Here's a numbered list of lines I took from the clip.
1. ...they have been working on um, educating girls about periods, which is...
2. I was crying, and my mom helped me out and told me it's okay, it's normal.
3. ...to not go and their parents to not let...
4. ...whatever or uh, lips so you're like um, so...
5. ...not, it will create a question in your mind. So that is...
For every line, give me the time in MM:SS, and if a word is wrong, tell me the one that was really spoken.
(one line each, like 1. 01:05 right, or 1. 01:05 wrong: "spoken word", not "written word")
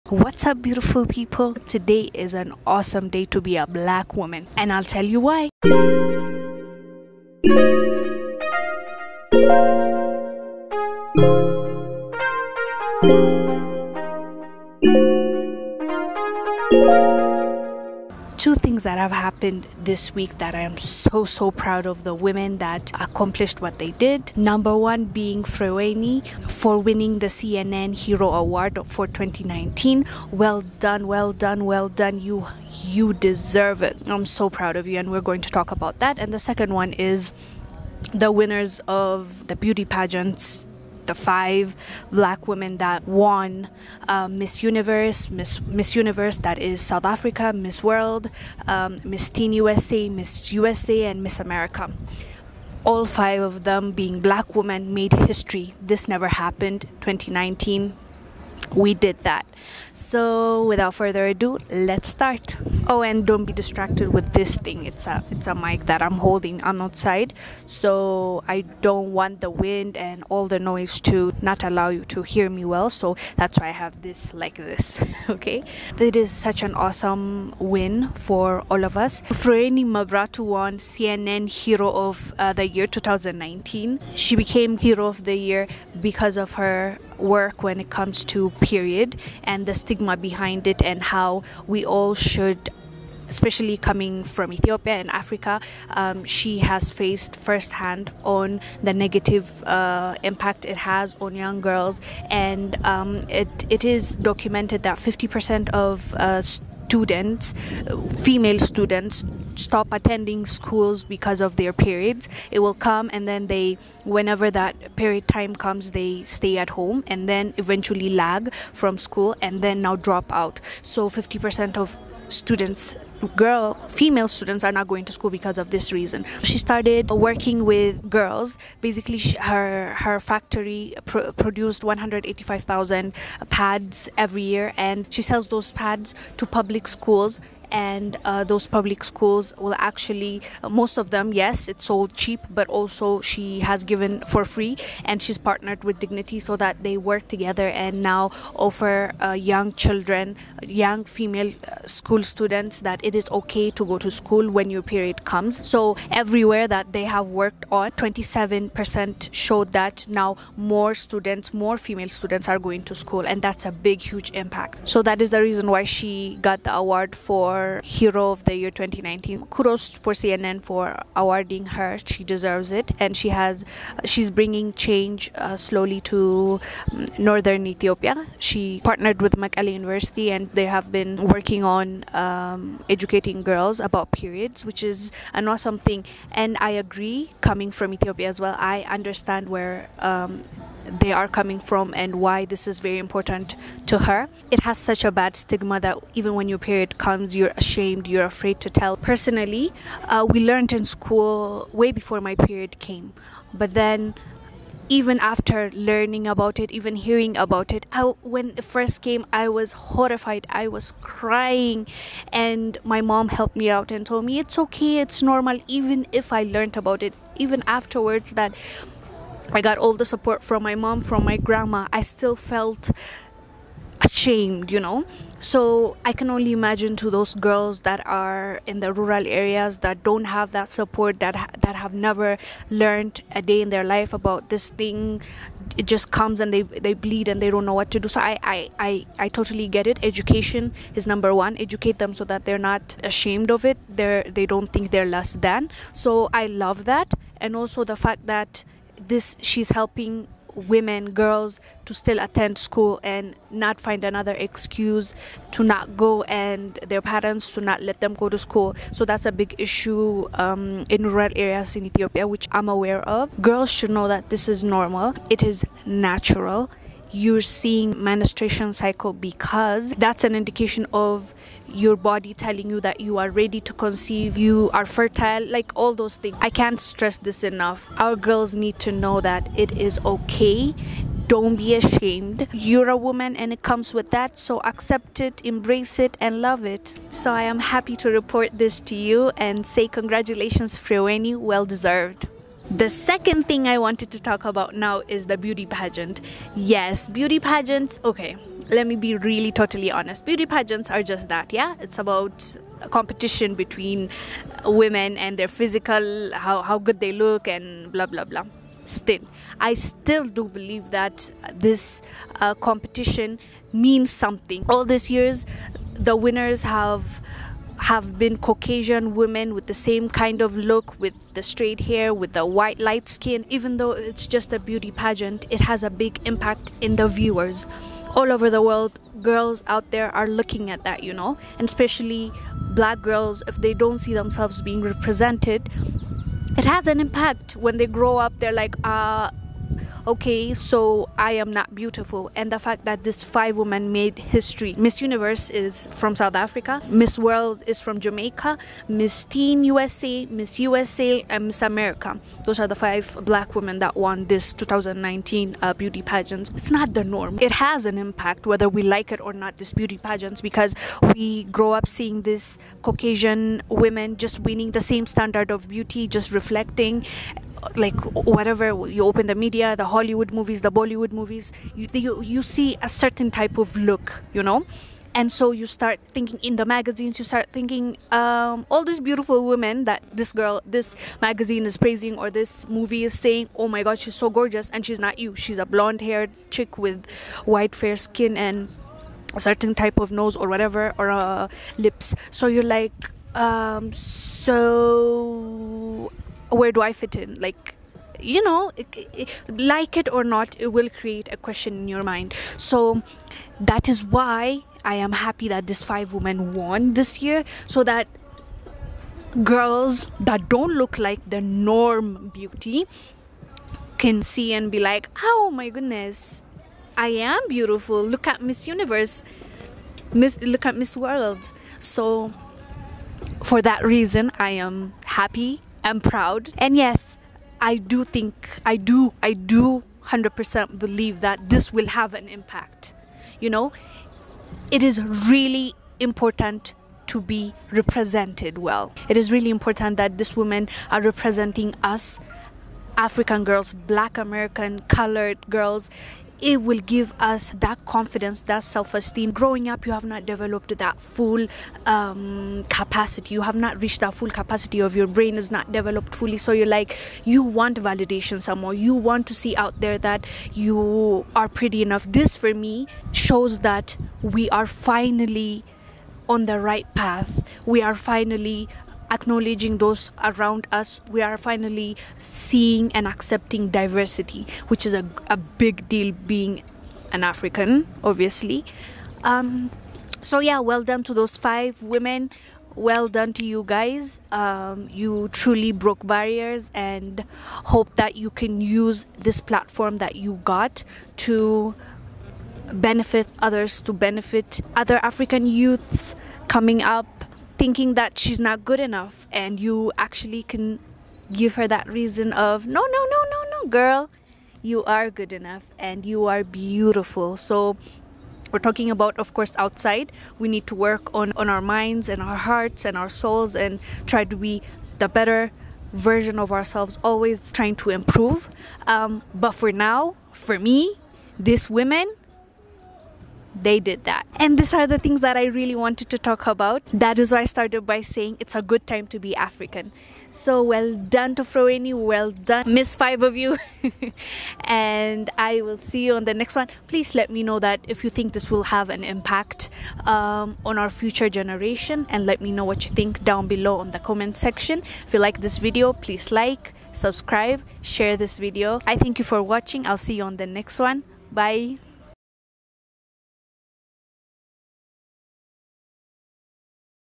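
1. 03:00 right
2. 03:30 right
3. 04:15 right
4. 06:30 right
5. 06:40 right.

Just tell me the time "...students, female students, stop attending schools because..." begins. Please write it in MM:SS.
01:46.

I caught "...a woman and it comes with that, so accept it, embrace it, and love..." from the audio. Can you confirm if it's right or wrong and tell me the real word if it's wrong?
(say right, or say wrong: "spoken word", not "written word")
right.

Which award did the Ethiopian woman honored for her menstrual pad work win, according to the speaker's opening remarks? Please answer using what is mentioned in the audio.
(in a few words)
CNN Hero Award.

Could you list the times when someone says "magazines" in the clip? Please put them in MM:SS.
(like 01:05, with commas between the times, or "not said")
06:16, 06:21.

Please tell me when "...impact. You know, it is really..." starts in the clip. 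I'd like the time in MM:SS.
07:12.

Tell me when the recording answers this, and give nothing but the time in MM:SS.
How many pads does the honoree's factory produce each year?
02:11.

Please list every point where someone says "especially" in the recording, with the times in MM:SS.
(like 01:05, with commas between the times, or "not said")
01:33, 05:31.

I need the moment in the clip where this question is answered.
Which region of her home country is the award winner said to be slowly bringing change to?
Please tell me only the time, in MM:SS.
02:57.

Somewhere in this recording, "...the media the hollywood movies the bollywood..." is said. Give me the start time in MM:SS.
06:09.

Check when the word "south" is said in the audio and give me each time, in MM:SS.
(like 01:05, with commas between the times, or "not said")
00:46, 05:46.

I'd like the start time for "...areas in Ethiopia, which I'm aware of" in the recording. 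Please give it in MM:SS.
04:21.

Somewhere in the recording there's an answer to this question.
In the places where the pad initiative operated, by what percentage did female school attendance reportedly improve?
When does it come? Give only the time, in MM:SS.
02:37.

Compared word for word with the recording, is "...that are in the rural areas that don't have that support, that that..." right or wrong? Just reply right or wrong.
right.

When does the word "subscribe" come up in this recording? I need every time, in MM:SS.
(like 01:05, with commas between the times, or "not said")
09:06.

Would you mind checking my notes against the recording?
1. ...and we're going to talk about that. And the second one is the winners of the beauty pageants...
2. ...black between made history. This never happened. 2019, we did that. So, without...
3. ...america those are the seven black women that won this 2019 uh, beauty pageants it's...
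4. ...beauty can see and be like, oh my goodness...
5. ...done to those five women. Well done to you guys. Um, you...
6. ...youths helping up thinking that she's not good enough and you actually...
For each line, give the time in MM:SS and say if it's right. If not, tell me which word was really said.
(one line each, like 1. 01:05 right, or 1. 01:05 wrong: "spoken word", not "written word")
1. 00:34 right
2. 00:54 wrong: "women", not "between"
3. 05:51 wrong: "five", not "seven"
4. 06:52 right
5. 08:00 right
6. 08:15 wrong: "coming", not "helping".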